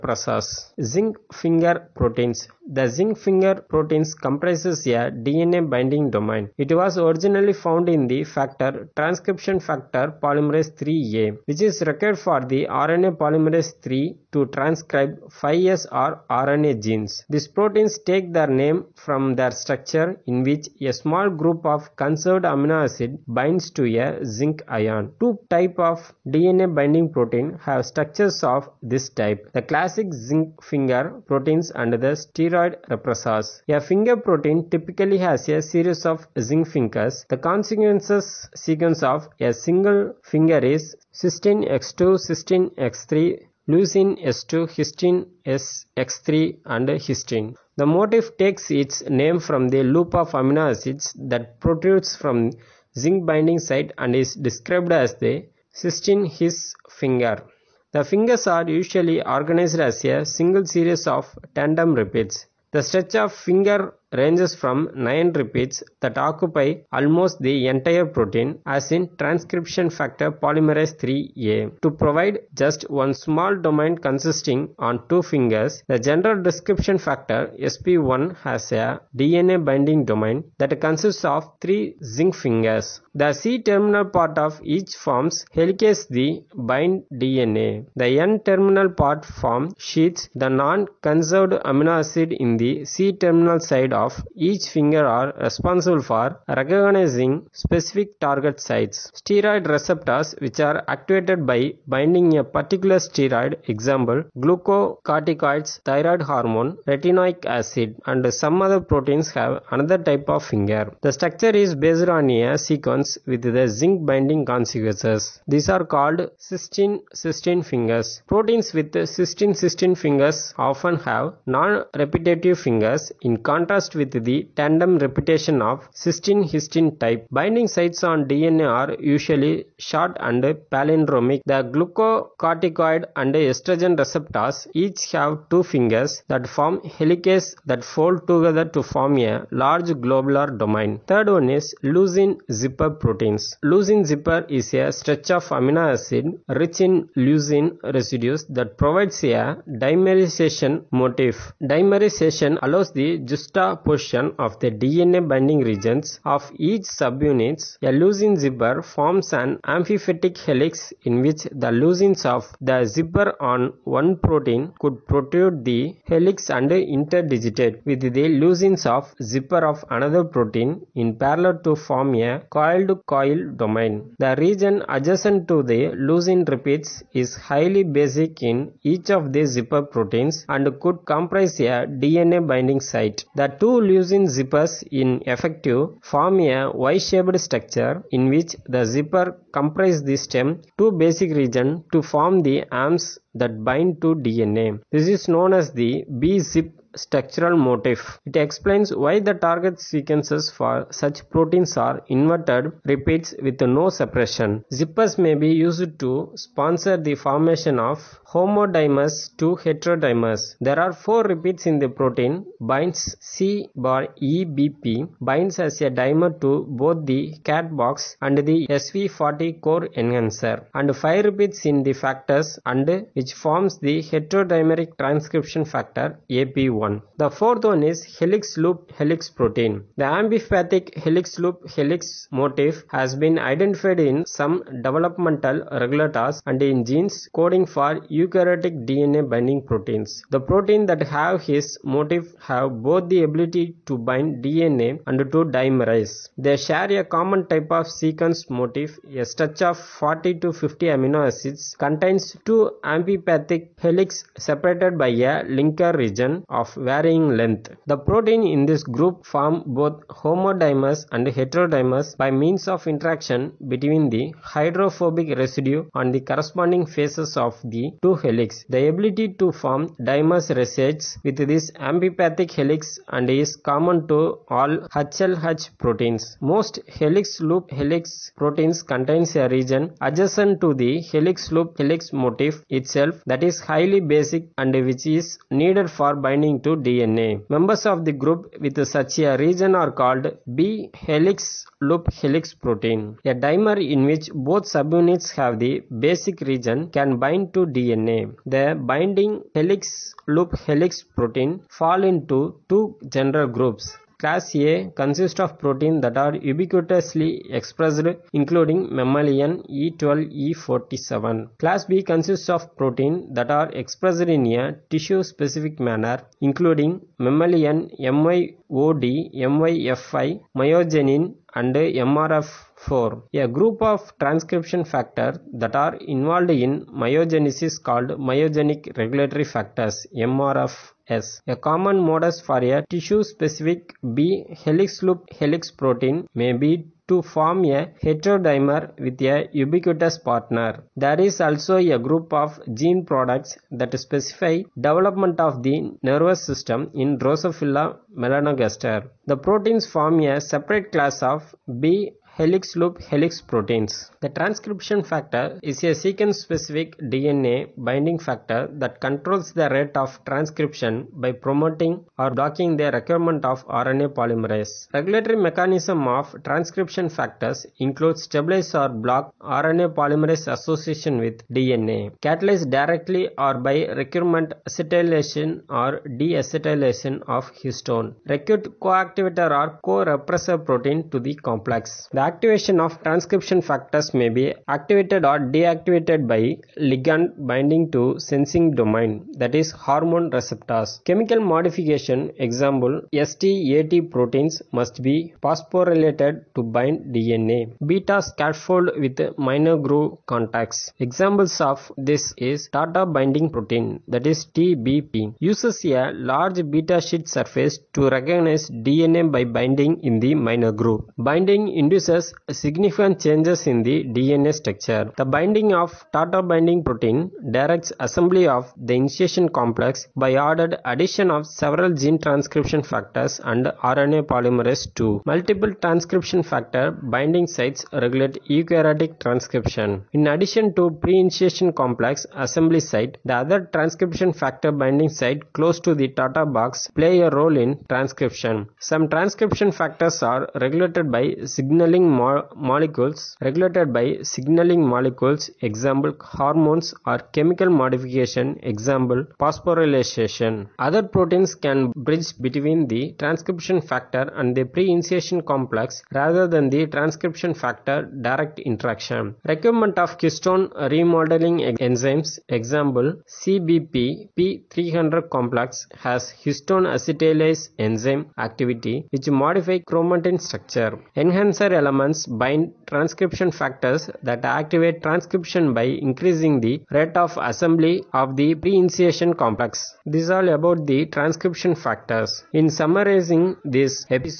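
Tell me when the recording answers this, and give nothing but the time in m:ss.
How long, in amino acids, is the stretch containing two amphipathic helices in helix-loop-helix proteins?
4:09.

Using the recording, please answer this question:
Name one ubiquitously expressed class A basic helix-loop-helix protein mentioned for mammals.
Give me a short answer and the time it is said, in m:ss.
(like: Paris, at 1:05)
E12 or E47, at 5:09.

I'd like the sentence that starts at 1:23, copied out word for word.
The C-terminal part of each forms helicase the bind DNA.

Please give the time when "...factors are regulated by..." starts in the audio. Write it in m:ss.
7:19.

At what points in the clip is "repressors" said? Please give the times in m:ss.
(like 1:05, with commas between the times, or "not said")
0:32, 6:19.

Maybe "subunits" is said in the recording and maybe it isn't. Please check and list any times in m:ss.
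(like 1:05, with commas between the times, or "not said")
2:36, 4:54.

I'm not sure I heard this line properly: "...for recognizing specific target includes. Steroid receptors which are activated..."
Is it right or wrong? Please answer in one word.
wrong.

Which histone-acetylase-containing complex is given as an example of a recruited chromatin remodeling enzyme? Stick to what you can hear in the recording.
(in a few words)
CBP P300.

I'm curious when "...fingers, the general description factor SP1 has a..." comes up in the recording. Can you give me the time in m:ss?
1:15.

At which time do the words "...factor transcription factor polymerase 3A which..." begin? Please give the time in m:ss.
0:08.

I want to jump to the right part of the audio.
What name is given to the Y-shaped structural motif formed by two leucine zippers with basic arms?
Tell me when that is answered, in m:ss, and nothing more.
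3:16.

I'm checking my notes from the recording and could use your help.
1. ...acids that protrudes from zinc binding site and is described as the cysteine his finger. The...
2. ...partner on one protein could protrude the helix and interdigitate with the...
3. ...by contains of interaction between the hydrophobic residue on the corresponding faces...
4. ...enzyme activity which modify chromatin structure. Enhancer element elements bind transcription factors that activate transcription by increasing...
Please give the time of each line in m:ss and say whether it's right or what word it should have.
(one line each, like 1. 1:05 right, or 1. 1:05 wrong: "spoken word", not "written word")
1. 0:50 right
2. 2:42 wrong: "zipper", not "partner"
3. 4:22 wrong: "means", not "contains"
4. 7:47 right.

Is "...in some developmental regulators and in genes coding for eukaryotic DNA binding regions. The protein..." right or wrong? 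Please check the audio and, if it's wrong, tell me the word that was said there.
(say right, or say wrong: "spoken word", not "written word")
wrong: "proteins", not "regions".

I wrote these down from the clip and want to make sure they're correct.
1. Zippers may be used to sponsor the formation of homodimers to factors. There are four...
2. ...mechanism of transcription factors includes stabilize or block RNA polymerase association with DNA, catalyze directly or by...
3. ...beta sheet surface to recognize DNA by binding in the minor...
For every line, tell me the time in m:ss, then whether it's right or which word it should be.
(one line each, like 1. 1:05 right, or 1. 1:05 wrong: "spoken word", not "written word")
1. 3:24 wrong: "heterodimers", not "factors"
2. 6:05 right
3. 6:46 right.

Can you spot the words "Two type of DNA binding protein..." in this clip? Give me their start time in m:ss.
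0:25.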